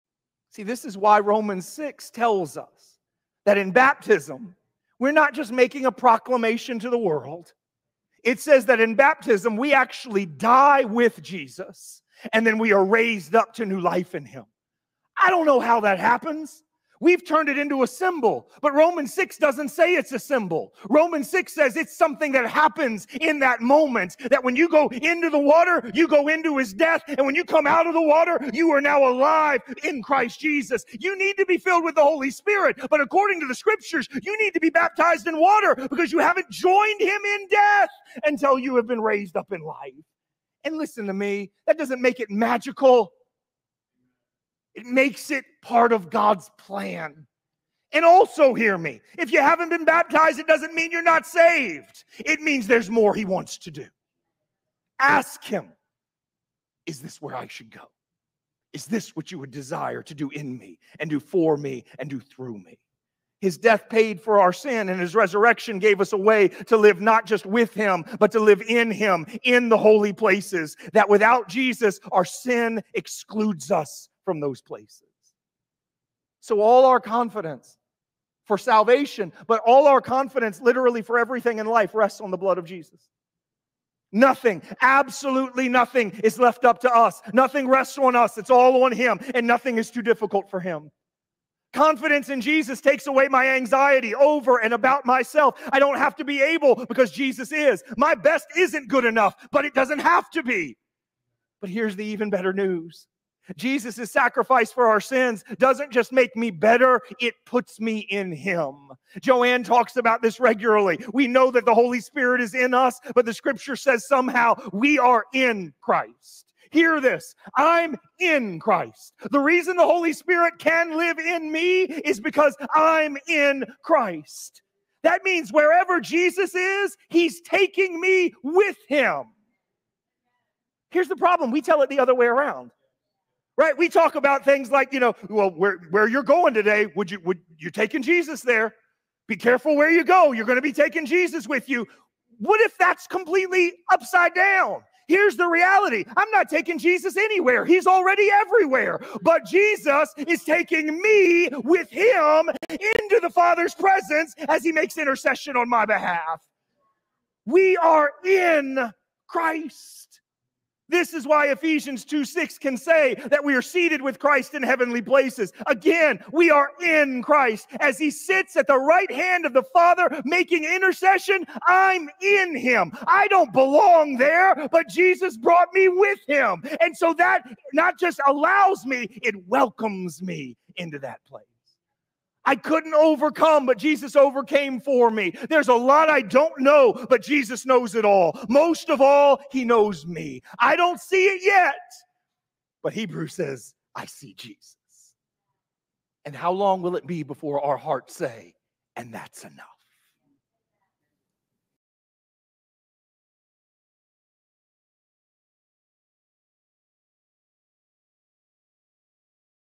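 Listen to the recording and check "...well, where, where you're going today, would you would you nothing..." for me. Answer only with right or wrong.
wrong.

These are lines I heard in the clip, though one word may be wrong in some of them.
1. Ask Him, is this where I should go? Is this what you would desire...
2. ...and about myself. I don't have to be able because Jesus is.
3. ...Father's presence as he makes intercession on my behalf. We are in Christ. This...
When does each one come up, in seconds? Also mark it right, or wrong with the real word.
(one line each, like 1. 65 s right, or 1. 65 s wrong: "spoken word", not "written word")
1. 54 s right
2. 94 s right
3. 153 s right.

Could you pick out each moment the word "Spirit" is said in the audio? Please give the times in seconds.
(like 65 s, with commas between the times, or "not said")
32 s, 112 s, 120 s.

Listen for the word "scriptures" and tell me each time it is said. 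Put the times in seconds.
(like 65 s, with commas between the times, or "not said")
33 s, 113 s.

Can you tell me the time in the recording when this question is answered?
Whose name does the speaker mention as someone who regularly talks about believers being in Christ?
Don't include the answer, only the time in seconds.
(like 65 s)
109 s.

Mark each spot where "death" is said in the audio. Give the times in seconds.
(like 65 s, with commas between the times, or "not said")
26 s, 37 s, 63 s.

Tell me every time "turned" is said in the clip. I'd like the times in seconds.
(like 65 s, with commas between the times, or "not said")
17 s.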